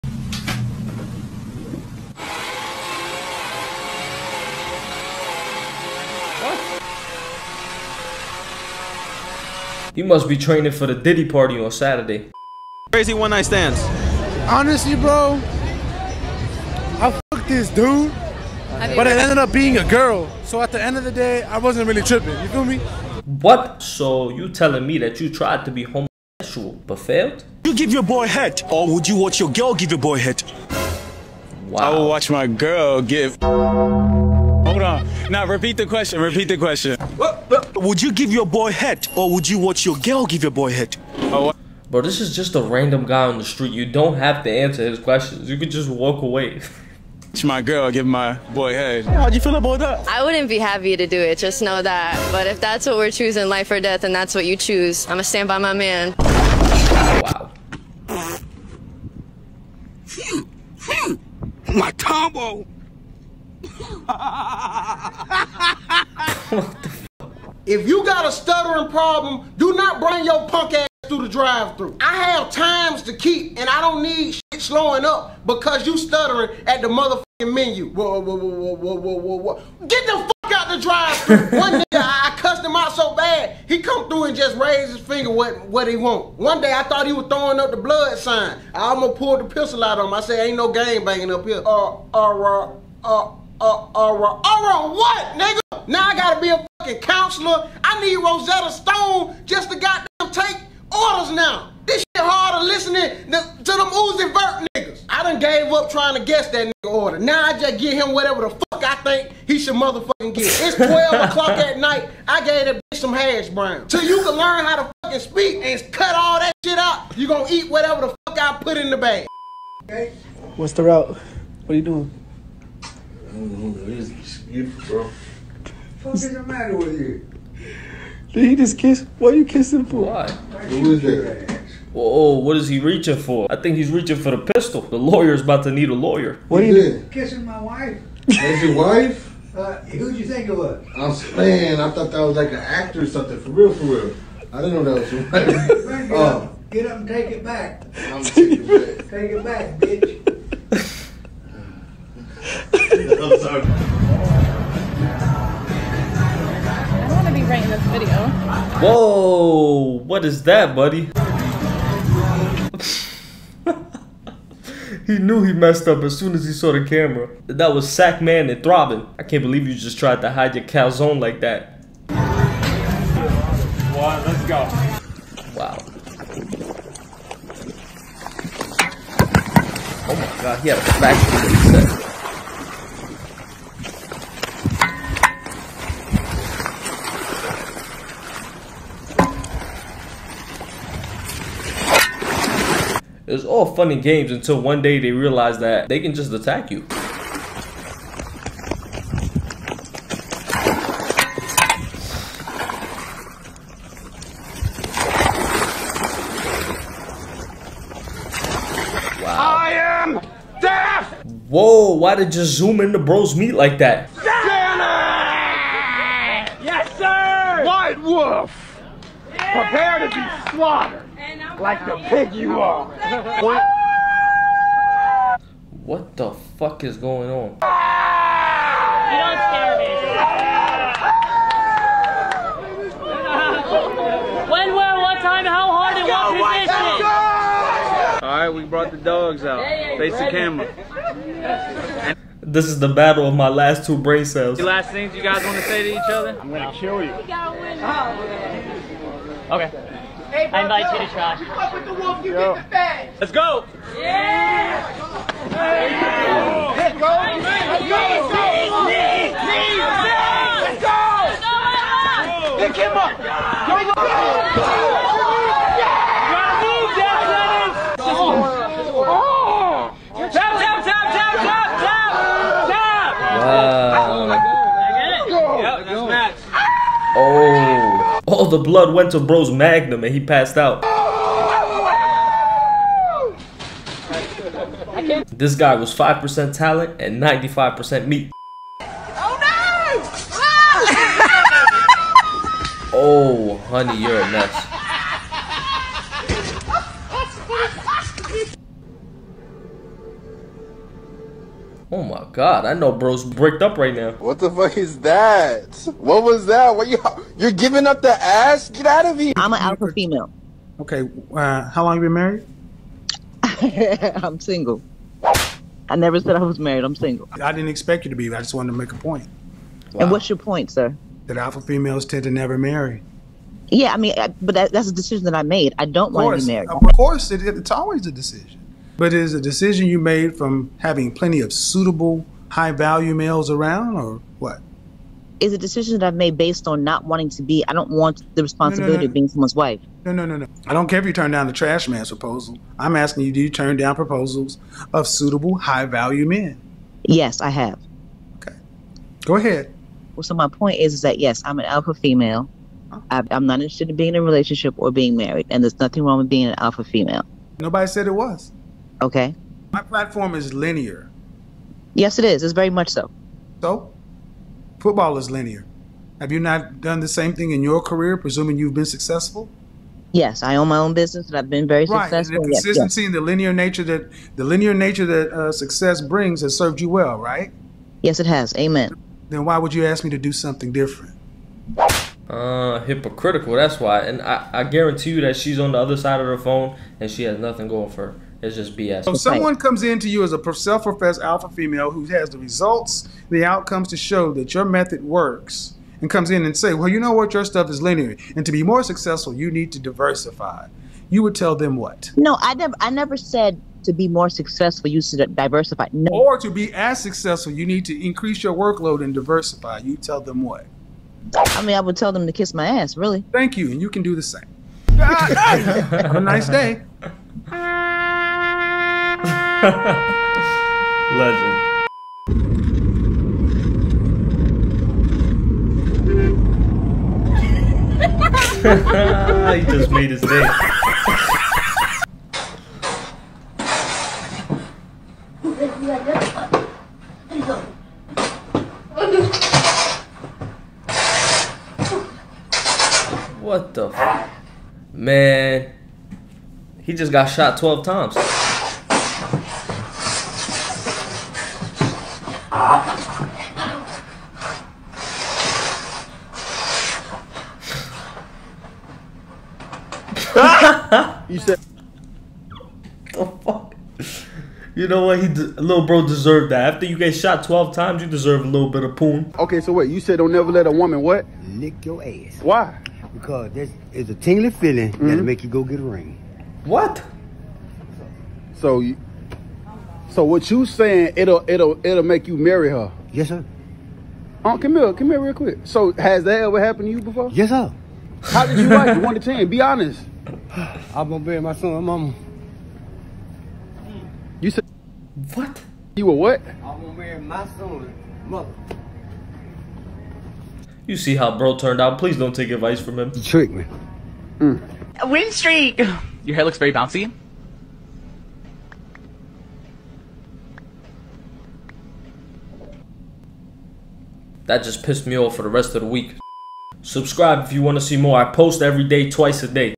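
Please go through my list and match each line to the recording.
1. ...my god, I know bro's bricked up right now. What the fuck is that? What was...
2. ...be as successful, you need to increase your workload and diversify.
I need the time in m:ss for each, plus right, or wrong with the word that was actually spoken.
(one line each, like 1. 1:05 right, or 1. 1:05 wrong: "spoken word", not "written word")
1. 5:02 right
2. 6:46 right.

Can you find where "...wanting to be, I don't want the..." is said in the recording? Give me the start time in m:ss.
5:37.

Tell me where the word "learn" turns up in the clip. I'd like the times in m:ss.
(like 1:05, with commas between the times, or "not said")
1:54.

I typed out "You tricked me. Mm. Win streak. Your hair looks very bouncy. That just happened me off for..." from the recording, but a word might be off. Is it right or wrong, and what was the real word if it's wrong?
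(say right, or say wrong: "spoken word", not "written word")
wrong: "pissed", not "happened".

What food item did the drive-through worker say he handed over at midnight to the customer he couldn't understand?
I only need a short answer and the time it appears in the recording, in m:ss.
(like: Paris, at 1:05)
Hash brown, at 1:53.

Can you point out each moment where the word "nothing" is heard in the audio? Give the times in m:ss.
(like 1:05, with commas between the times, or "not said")
5:55, 6:27.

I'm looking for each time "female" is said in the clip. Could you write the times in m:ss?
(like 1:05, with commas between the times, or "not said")
5:09, 5:21, 5:51, 5:56, 6:31.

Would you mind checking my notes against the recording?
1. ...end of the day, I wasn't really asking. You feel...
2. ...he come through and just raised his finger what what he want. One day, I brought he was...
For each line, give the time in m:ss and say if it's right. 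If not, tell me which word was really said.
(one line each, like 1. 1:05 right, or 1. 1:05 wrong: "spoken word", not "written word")
1. 0:20 wrong: "tripping", not "asking"
2. 1:23 wrong: "thought", not "brought".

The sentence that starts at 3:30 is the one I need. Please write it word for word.
Whoa, why did you zoom into bro's meat like that?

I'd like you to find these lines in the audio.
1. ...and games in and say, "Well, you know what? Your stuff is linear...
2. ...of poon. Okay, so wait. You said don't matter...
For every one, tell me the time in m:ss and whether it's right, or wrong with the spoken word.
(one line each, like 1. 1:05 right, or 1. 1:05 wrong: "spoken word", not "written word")
1. 6:36 wrong: "comes", not "games"
2. 7:48 wrong: "never", not "matter".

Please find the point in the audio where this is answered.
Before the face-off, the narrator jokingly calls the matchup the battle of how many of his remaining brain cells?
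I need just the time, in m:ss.
4:03.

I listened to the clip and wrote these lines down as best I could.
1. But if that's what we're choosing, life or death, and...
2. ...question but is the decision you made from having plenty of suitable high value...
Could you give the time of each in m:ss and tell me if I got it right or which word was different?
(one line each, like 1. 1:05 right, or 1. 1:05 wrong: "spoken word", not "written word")
1. 0:52 right
2. 5:28 wrong: "decision", not "question".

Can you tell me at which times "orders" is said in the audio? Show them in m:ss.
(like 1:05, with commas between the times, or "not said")
1:40, 1:46.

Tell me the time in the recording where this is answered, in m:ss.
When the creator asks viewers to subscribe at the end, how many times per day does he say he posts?
8:39.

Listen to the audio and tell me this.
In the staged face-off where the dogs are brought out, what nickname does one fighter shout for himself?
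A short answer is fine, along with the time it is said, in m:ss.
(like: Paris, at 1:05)
White Wolf, at 3:37.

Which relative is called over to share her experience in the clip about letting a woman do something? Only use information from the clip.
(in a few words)
Aunt Camille.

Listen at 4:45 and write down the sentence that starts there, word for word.
This guy was 5% talent and 95% meat.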